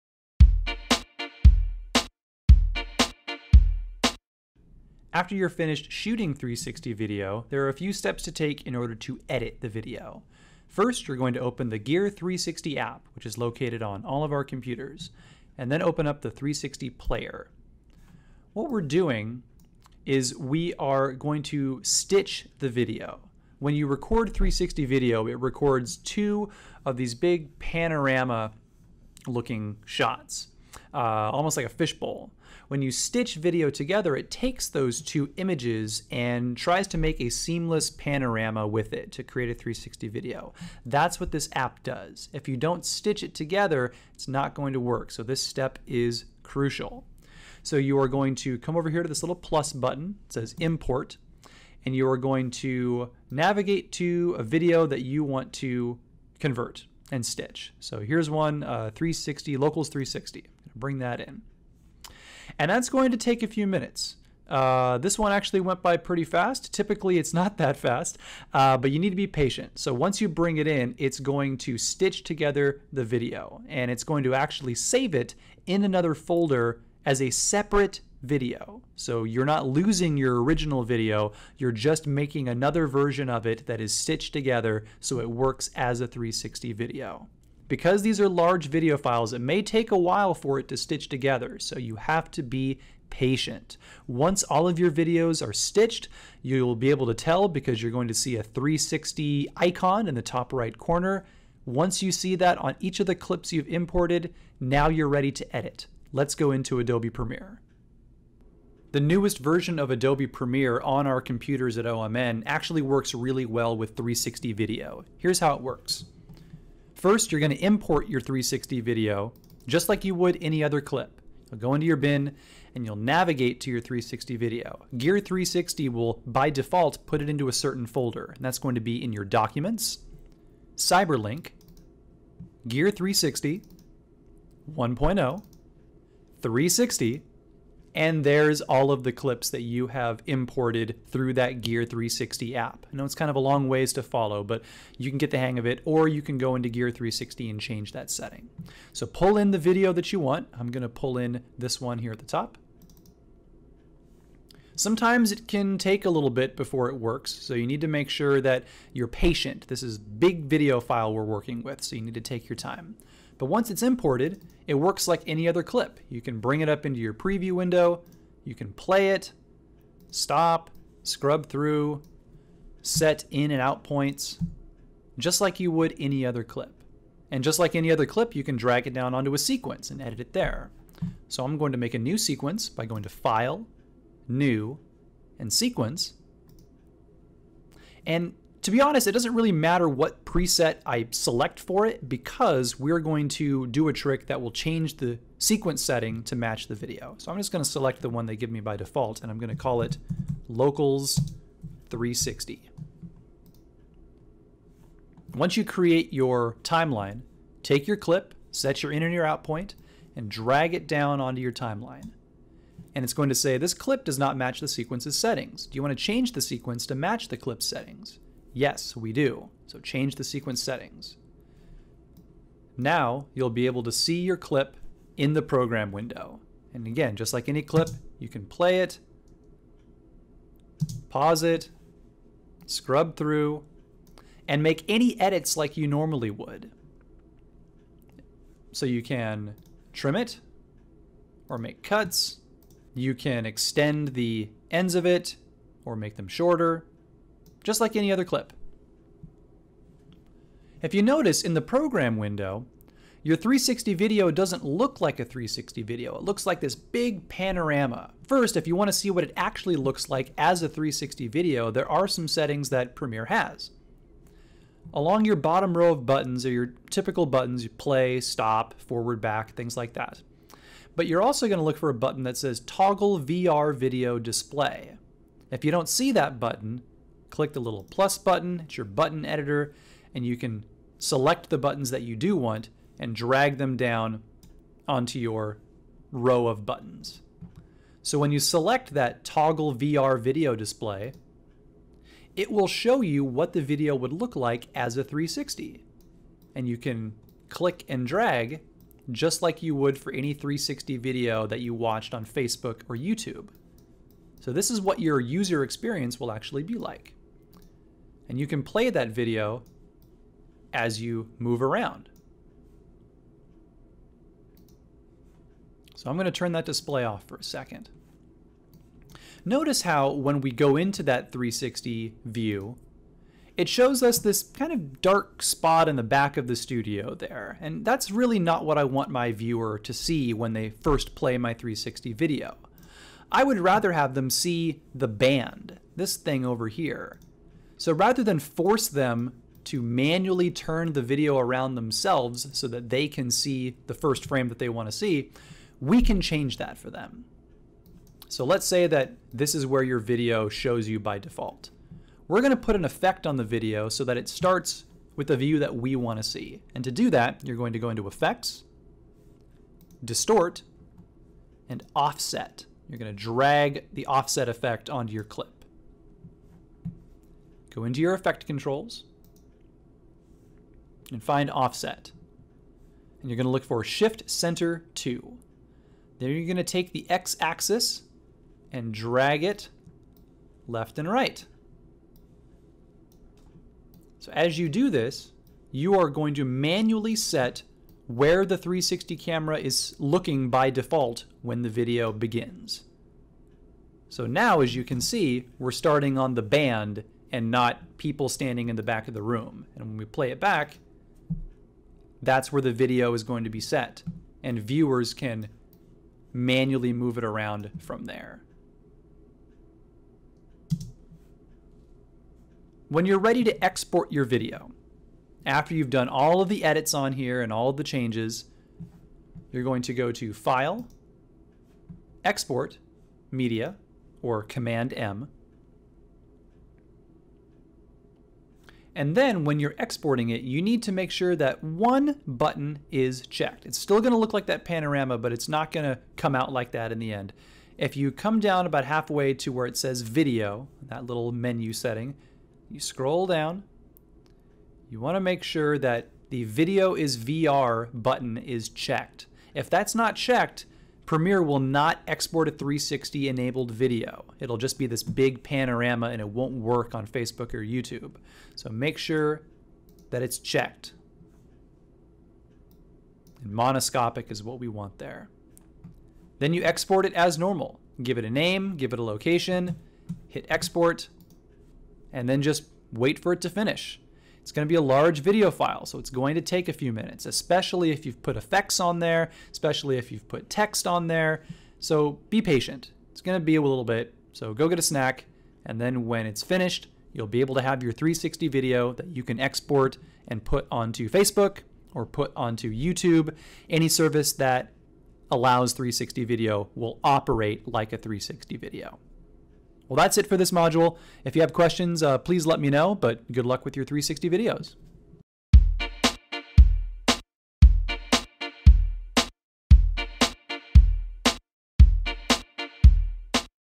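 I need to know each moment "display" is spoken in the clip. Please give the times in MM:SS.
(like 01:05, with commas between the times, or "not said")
04:34, 04:50, 05:16.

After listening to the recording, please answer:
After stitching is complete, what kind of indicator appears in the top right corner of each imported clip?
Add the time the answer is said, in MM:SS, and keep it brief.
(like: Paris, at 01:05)
360 icon, at 01:38.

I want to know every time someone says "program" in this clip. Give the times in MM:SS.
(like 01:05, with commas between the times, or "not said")
03:45, 04:11.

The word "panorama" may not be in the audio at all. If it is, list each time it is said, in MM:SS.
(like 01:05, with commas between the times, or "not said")
00:27, 00:37, 04:17, 07:14, 07:35.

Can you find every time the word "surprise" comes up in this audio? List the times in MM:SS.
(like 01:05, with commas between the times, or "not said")
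not said.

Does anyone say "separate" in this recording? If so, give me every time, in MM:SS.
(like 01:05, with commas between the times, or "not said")
01:17.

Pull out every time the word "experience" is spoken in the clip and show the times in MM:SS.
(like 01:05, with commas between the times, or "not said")
05:05.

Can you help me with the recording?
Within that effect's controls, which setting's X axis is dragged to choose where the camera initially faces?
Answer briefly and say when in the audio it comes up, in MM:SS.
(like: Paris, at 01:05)
Shift center to, at 06:13.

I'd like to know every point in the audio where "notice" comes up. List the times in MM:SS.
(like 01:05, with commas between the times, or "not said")
04:11, 05:19.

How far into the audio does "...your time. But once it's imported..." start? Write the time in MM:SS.
02:42.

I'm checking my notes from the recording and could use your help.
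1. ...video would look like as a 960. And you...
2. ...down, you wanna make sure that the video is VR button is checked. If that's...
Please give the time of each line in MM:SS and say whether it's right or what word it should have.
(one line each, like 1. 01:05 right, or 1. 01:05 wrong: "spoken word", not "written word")
1. 04:53 wrong: "360", not "960"
2. 07:23 right.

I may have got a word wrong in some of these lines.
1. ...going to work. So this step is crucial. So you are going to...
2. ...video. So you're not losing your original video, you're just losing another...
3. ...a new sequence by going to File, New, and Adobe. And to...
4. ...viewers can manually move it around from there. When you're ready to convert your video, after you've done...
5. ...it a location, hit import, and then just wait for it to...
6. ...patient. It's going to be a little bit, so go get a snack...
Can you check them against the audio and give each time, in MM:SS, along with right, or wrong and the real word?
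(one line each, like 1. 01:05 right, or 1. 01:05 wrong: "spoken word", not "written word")
1. 00:44 right
2. 01:18 wrong: "making", not "losing"
3. 03:01 wrong: "Sequence", not "Adobe"
4. 06:44 wrong: "export", not "convert"
5. 07:48 wrong: "export", not "import"
6. 08:02 right.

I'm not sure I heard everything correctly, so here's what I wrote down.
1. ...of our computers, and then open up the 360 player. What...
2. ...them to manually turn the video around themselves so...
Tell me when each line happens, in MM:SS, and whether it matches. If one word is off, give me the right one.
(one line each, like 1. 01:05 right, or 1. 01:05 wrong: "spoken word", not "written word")
1. 00:14 right
2. 05:38 right.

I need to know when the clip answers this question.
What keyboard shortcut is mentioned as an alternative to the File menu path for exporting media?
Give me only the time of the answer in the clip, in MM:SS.
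07:04.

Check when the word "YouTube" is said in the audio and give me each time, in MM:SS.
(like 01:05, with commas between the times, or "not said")
05:02, 07:37, 08:12.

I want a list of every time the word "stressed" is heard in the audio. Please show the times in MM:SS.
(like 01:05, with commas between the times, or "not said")
not said.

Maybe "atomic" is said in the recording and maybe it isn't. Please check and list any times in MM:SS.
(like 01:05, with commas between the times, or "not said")
not said.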